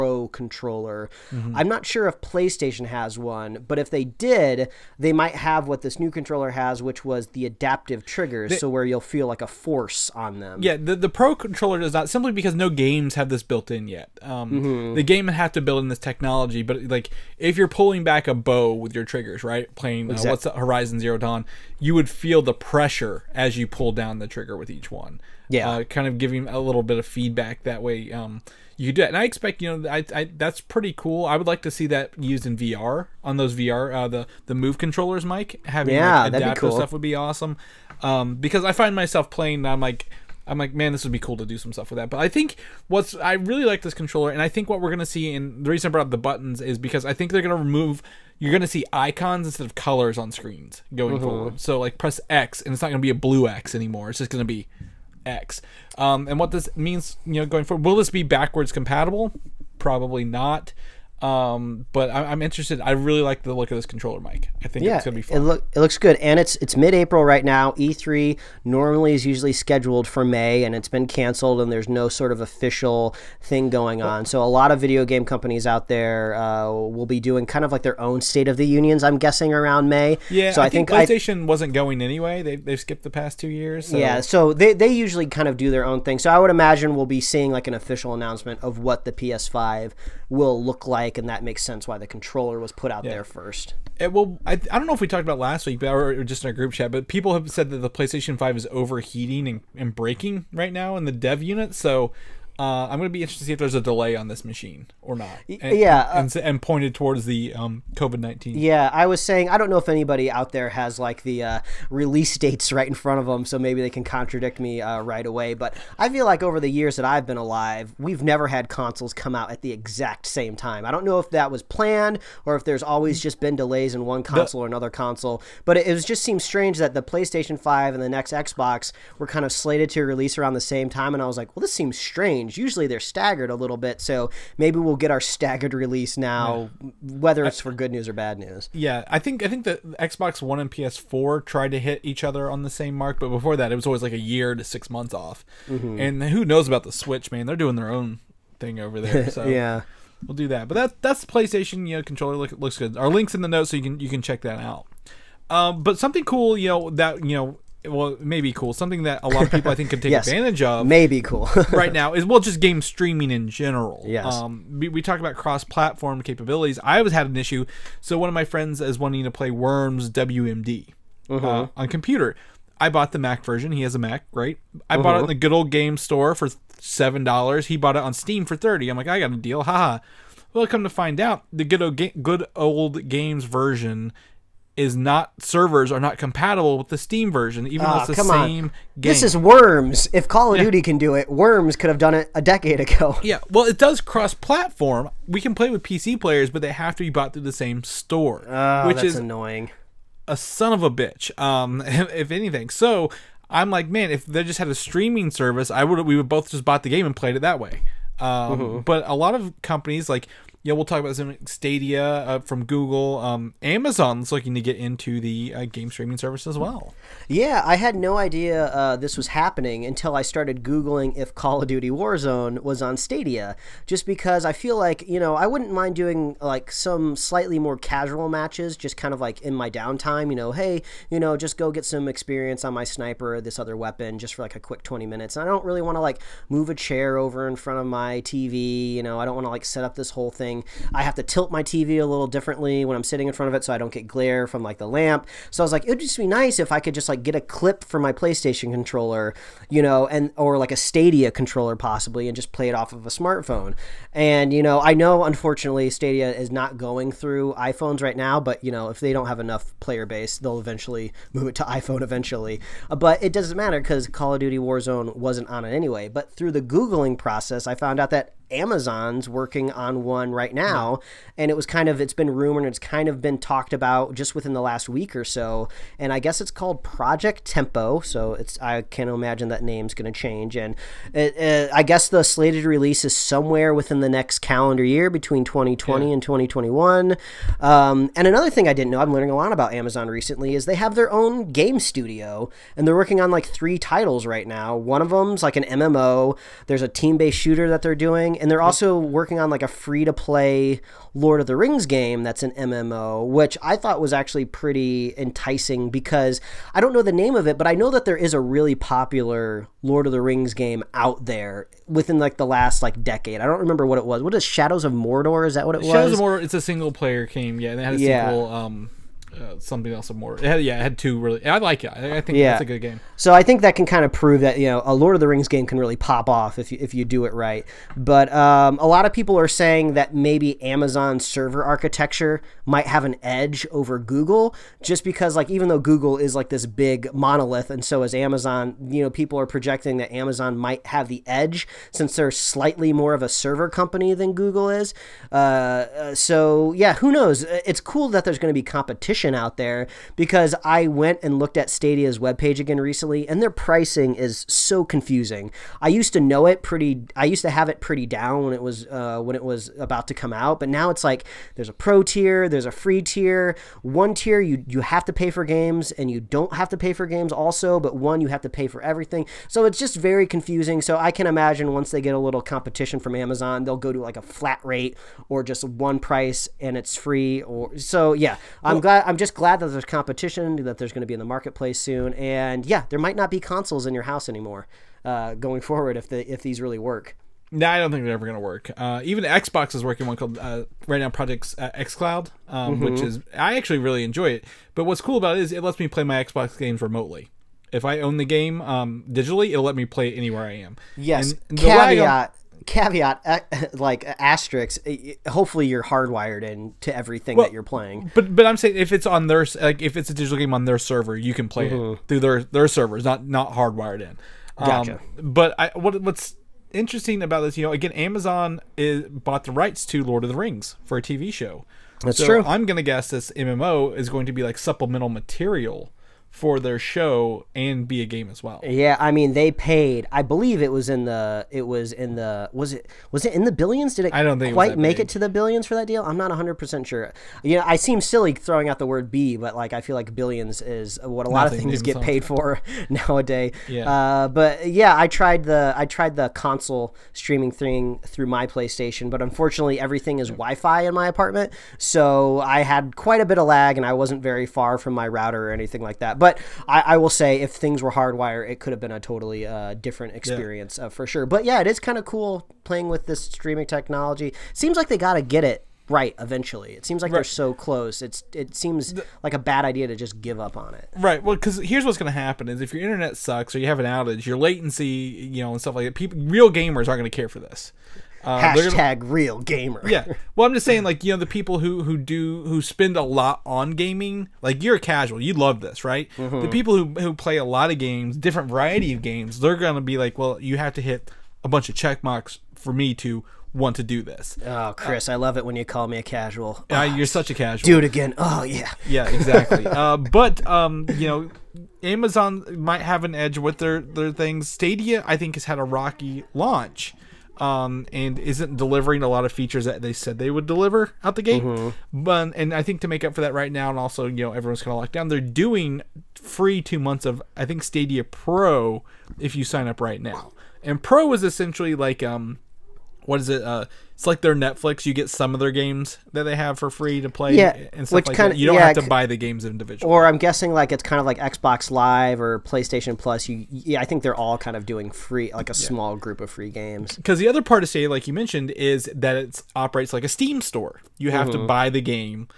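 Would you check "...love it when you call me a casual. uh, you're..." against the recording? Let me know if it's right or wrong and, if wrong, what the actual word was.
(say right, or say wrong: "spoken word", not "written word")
right.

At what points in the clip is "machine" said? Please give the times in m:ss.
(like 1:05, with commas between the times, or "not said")
1:44.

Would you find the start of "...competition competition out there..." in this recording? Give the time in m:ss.
5:48.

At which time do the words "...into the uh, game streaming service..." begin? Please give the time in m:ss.
3:34.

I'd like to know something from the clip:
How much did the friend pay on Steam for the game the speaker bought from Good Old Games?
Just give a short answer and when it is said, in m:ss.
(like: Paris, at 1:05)
$30, at 2:58.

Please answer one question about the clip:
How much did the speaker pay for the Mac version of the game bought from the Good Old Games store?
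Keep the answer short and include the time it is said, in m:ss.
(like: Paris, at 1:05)
$7, at 2:56.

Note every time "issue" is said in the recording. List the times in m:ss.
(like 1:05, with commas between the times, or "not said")
2:47.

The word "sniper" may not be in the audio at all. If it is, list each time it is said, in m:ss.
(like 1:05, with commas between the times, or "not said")
3:52.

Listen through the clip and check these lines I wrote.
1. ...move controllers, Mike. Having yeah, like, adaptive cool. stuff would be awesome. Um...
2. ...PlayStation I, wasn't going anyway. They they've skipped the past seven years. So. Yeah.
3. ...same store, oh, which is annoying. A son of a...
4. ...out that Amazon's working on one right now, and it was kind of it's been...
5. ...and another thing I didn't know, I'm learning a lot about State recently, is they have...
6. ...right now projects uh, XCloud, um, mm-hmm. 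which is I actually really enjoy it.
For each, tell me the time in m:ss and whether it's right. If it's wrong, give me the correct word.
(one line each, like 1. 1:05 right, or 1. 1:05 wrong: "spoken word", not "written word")
1. 0:34 right
2. 1:21 wrong: "two", not "seven"
3. 3:17 right
4. 4:27 right
5. 4:48 wrong: "Amazon", not "State"
6. 6:30 right.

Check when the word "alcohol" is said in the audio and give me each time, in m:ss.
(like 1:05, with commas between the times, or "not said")
not said.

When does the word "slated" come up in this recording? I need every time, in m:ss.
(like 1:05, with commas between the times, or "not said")
2:09, 4:42.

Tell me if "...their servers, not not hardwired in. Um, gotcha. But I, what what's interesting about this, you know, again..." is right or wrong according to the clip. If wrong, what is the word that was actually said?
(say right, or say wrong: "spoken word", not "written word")
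right.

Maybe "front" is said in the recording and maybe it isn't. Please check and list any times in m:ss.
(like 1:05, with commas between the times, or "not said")
1:52, 3:57, 4:03.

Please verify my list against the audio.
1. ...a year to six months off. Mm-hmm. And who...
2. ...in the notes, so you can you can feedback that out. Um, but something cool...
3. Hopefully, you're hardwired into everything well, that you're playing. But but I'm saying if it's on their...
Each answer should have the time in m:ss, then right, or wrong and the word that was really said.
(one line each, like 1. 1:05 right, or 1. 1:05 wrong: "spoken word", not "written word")
1. 2:24 right
2. 2:33 wrong: "check", not "feedback"
3. 6:45 right.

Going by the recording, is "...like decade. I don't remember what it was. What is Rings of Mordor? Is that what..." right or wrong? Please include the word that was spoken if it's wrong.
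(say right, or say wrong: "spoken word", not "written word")
wrong: "Shadows", not "Rings".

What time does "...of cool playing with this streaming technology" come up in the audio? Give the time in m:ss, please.
7:41.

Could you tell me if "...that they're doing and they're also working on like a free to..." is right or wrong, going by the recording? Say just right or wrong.
right.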